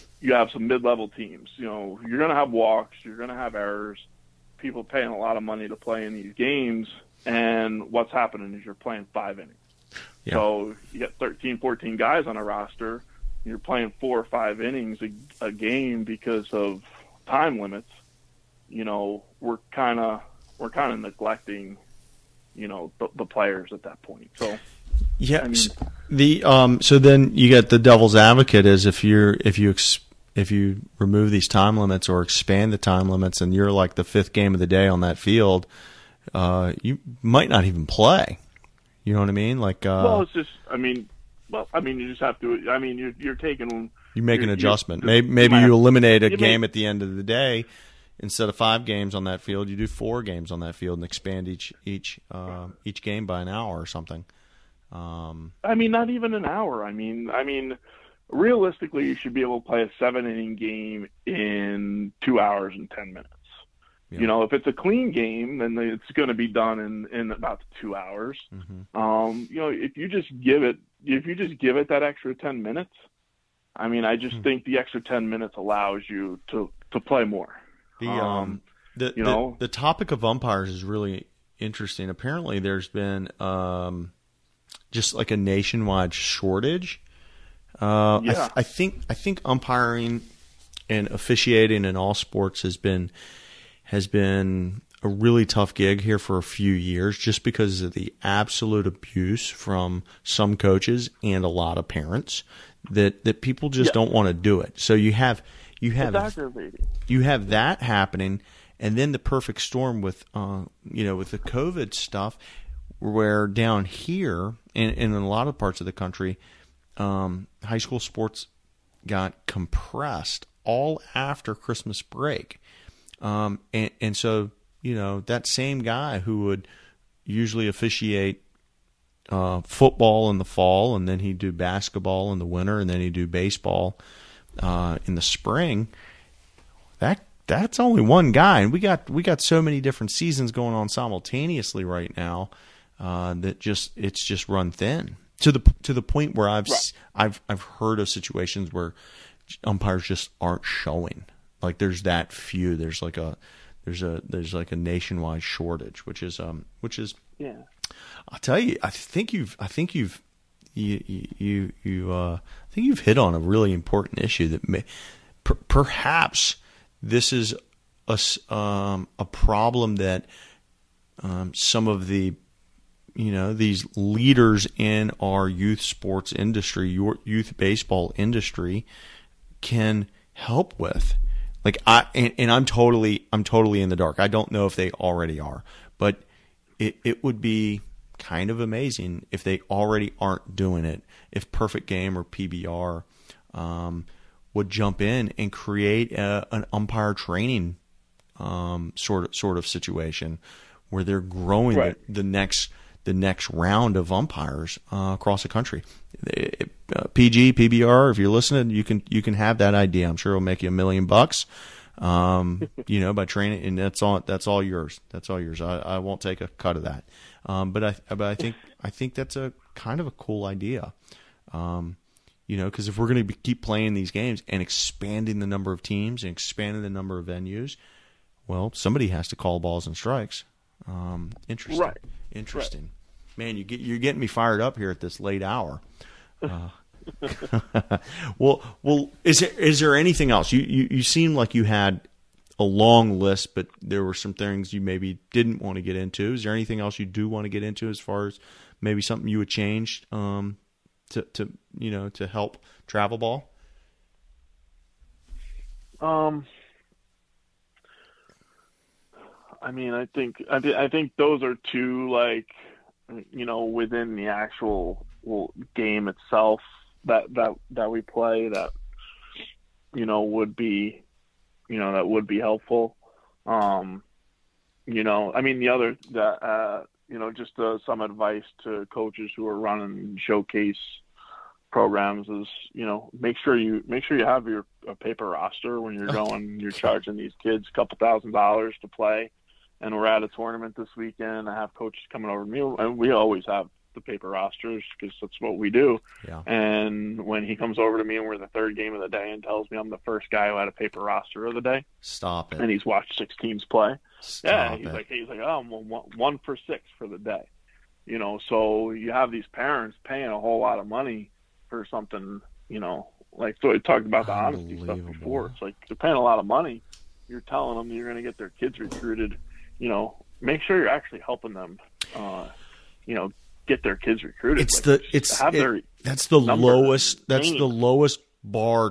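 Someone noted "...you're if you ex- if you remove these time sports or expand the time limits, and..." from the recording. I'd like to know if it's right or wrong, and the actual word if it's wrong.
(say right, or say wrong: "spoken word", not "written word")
wrong: "limits", not "sports".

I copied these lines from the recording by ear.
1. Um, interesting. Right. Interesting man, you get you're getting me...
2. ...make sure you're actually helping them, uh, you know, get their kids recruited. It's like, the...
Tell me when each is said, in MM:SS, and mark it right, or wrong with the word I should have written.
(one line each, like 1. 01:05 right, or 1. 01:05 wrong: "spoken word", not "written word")
1. 03:50 right
2. 05:20 right.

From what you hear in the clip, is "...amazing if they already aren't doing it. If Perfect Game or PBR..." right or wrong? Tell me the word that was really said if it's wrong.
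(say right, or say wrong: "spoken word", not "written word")
right.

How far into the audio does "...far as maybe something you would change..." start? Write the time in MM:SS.
04:08.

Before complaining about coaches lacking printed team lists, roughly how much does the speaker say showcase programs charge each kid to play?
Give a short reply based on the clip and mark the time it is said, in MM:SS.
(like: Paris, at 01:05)
a couple thousand dollars, at 04:47.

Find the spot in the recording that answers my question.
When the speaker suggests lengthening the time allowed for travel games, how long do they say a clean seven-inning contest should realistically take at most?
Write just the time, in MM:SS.
01:02.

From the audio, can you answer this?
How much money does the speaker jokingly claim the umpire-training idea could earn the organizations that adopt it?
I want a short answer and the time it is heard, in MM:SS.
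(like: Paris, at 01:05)
a million bucks, at 03:30.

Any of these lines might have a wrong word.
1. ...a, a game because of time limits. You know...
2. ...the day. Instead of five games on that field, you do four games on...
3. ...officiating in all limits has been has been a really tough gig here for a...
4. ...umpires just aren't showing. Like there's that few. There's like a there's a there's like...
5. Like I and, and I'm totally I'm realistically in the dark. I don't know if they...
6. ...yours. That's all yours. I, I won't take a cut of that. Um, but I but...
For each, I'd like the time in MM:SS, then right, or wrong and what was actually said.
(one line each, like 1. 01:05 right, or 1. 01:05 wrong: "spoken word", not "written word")
1. 00:15 right
2. 00:47 right
3. 01:31 wrong: "sports", not "limits"
4. 02:29 right
5. 03:01 wrong: "totally", not "realistically"
6. 03:34 right.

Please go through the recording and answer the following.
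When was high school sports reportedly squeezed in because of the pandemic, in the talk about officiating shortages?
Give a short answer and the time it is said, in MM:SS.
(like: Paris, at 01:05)
after Christmas break, at 02:01.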